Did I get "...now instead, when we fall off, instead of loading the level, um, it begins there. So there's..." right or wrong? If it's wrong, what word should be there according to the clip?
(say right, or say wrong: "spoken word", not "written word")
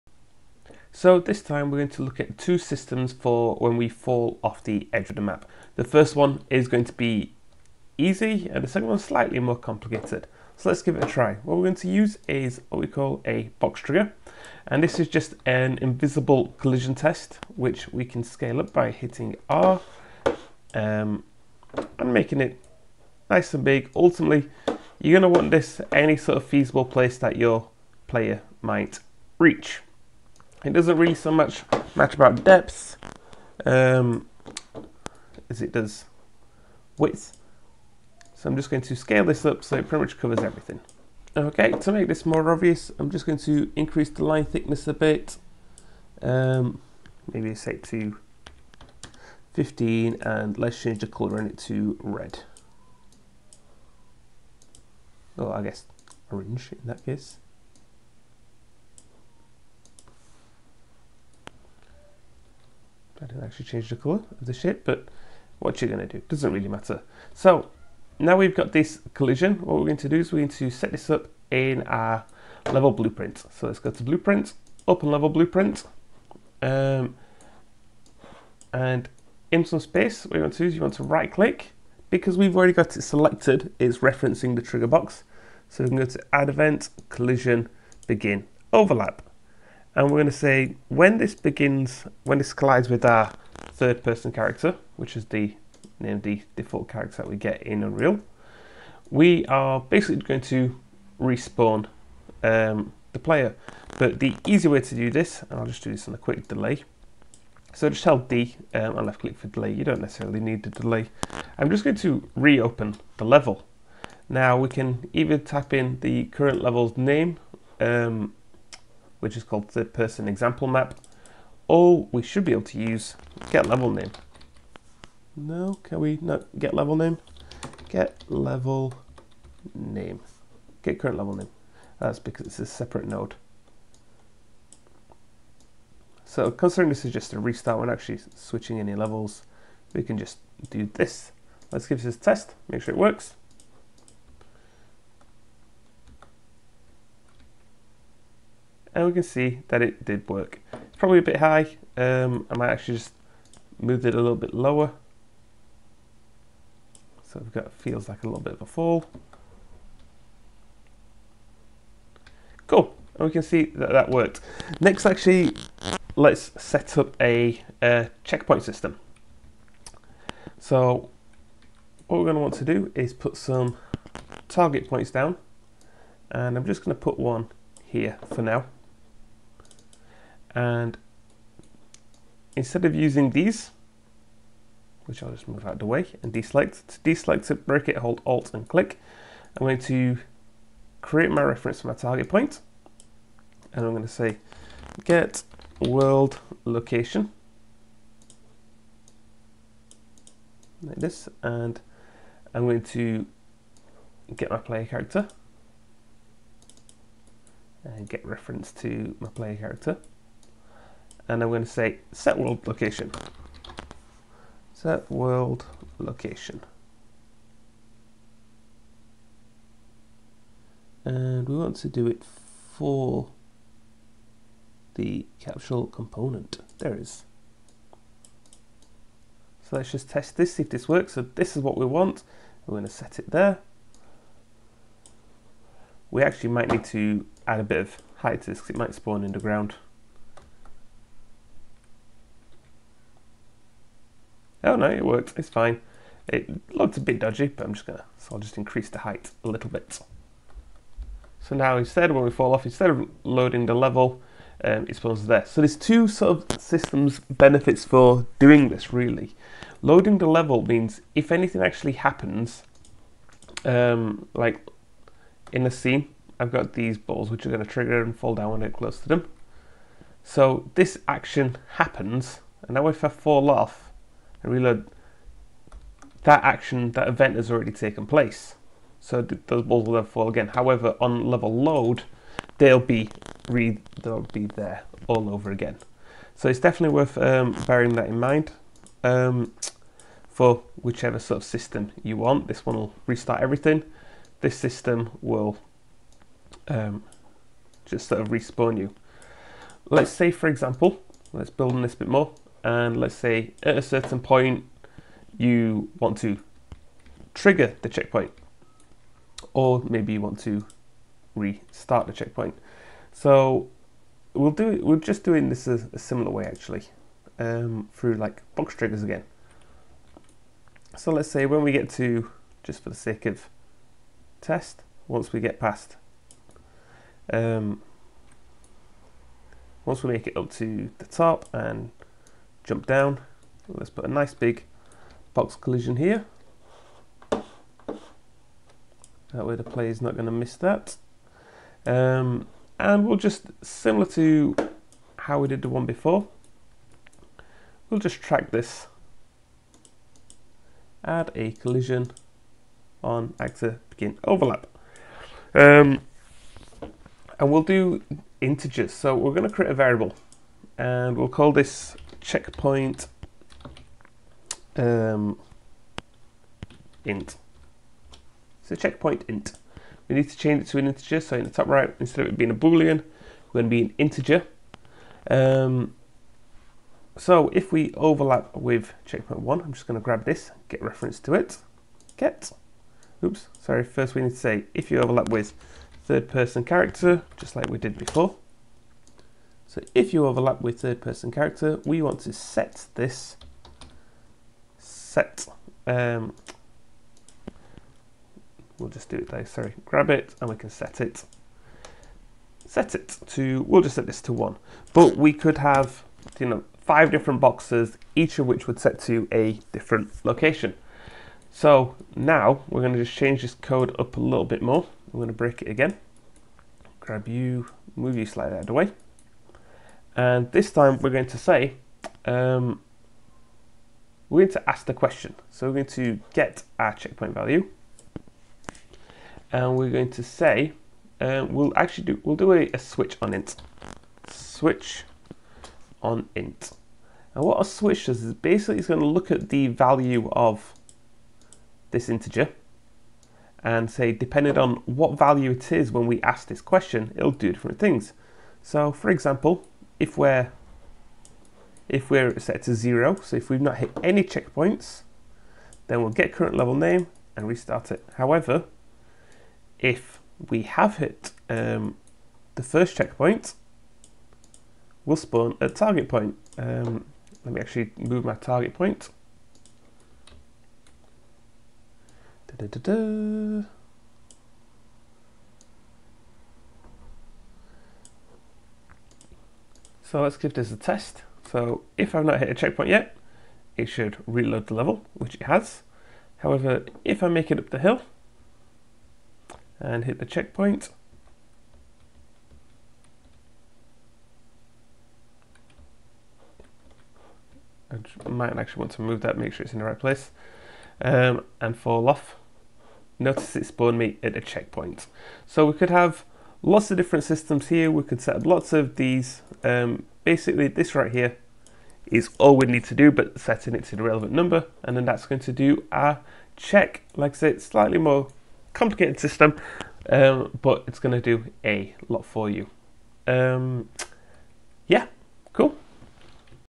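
wrong: "spawns", not "begins".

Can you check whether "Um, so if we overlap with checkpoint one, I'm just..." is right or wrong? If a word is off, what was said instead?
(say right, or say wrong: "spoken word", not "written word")
right.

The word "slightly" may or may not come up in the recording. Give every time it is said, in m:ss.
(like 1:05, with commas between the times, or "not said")
0:08, 6:58, 8:37.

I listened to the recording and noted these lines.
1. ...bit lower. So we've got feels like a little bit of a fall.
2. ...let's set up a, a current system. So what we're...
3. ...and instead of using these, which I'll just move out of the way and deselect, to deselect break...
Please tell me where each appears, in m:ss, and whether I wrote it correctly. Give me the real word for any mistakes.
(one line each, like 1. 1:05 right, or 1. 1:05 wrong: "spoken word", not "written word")
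1. 2:34 right
2. 2:46 wrong: "checkpoint", not "current"
3. 3:00 right.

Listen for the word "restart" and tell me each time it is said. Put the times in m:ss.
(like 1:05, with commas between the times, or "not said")
2:17, 4:53, 5:11, 7:37.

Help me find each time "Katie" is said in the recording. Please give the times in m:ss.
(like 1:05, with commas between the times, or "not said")
not said.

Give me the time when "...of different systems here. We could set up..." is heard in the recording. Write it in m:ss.
8:26.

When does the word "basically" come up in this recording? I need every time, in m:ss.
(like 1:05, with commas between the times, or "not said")
1:39, 7:18, 8:30.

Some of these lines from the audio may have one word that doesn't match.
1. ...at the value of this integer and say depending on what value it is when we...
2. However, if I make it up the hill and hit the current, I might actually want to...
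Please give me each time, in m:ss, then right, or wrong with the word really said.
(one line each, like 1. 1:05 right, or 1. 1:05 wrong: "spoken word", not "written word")
1. 7:19 right
2. 8:06 wrong: "checkpoint", not "current".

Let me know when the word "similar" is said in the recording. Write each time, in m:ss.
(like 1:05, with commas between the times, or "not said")
5:15, 5:43.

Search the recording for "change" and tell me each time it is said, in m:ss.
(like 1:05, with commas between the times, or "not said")
0:50, 1:03, 6:10, 6:53.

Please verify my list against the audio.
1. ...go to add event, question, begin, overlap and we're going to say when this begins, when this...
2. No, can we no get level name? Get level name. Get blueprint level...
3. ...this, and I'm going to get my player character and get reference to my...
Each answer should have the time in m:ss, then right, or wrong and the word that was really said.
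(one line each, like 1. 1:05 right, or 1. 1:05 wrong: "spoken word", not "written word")
1. 1:25 wrong: "collision", not "question"
2. 2:05 wrong: "current", not "blueprint"
3. 3:20 right.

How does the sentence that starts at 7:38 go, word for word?
However, if we have hit um, the first checkpoint, we'll spawn a target point.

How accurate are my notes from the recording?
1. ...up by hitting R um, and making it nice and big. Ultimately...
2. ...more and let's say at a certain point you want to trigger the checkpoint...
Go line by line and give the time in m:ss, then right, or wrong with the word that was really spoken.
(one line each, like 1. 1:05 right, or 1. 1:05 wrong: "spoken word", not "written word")
1. 0:18 right
2. 5:02 right.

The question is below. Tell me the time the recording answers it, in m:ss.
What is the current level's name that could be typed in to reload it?
1:59.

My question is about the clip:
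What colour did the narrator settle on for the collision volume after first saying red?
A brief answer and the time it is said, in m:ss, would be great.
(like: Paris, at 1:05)
Orange, at 0:56.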